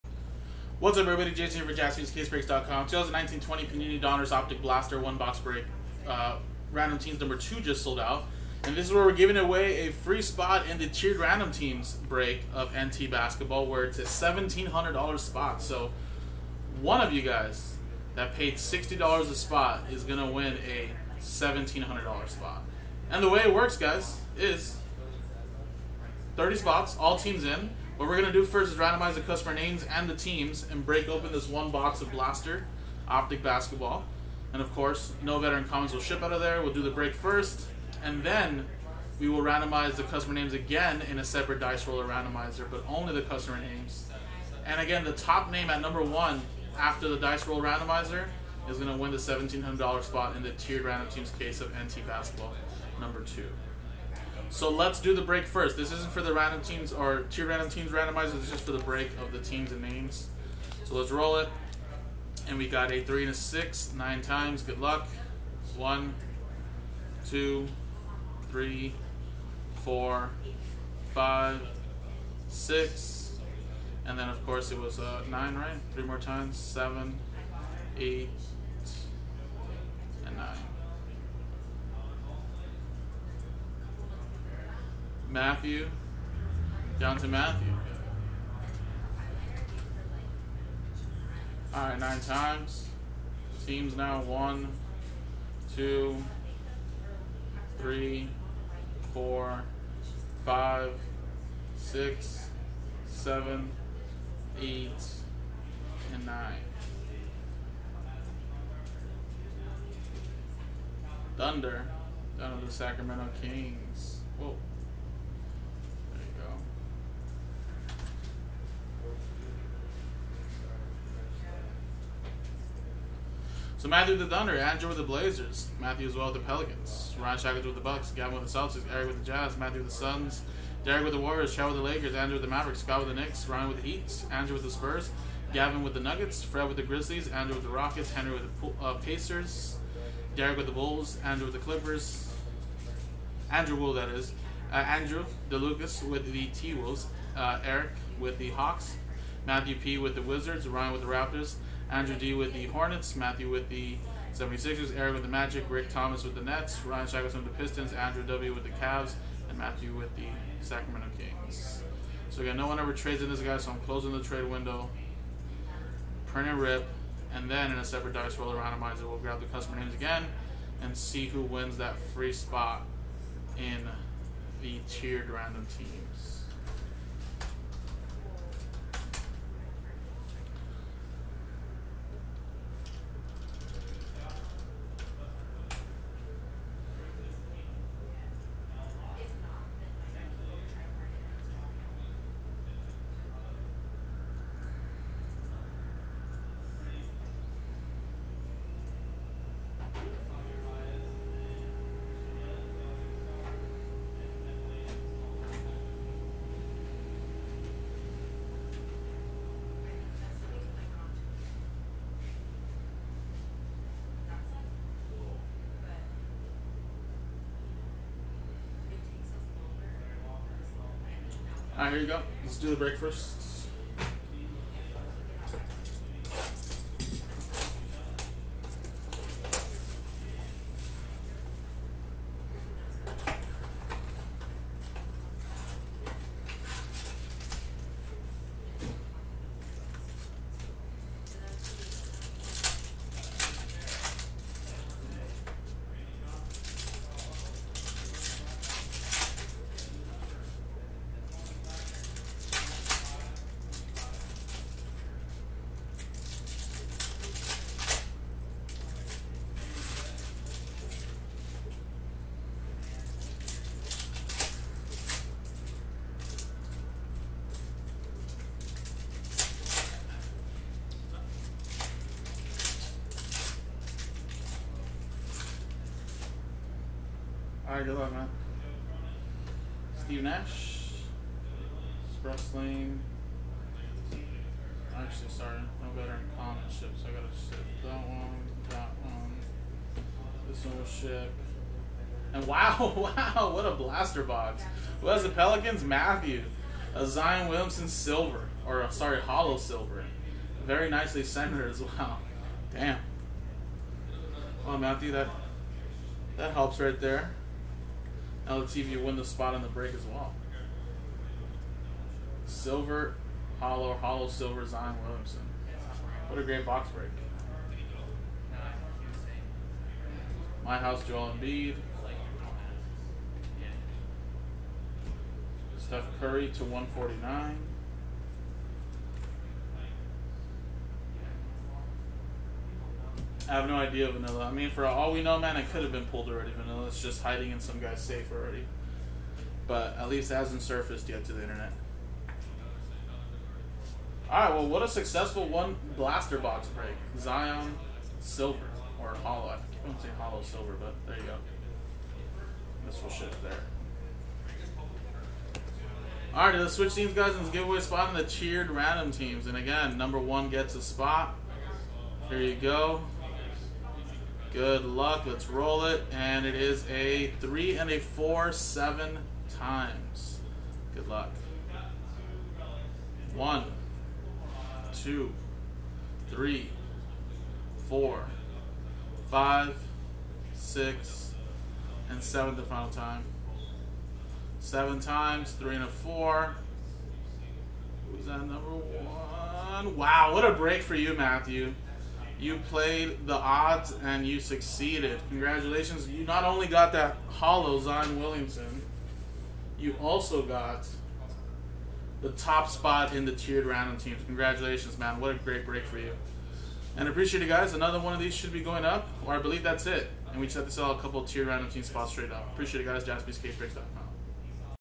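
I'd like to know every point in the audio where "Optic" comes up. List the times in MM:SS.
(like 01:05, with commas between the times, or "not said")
00:04, 00:33.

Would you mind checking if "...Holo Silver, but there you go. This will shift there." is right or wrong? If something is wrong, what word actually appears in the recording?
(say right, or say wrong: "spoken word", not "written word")
right.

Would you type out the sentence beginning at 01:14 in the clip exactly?
And then, of course, it was uh, nine, right?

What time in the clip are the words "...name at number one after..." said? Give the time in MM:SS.
00:45.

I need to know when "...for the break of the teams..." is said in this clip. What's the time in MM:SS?
00:58.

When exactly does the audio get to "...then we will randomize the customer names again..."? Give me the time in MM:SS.
00:38.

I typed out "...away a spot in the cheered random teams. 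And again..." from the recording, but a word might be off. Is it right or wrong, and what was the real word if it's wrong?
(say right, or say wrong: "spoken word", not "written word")
right.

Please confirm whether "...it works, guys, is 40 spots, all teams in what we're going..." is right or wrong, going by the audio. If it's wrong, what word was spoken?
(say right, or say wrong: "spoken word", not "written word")
wrong: "30", not "40".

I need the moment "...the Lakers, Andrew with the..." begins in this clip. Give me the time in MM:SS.
02:11.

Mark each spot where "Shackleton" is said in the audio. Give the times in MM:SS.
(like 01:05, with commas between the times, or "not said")
02:07, 02:37.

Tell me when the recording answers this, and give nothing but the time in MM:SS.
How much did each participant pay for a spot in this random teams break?
00:18.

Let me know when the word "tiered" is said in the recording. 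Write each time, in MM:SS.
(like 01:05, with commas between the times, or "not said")
00:10, 00:50, 02:54, 06:43, 06:51.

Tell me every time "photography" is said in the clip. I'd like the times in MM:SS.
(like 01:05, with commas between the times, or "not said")
not said.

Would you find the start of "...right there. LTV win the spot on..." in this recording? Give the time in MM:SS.
05:06.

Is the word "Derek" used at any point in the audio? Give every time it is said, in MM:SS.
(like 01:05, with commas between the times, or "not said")
02:10, 02:20.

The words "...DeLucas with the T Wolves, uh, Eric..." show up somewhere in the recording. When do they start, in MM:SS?
02:25.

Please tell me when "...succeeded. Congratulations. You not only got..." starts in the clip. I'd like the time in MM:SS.
06:34.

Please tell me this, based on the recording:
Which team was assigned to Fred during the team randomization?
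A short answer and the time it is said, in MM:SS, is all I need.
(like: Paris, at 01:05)
Grizzlies, at 02:16.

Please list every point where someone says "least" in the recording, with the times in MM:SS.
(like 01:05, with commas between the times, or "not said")
05:40.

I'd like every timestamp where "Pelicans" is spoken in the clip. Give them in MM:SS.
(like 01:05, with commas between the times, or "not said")
02:06, 04:55.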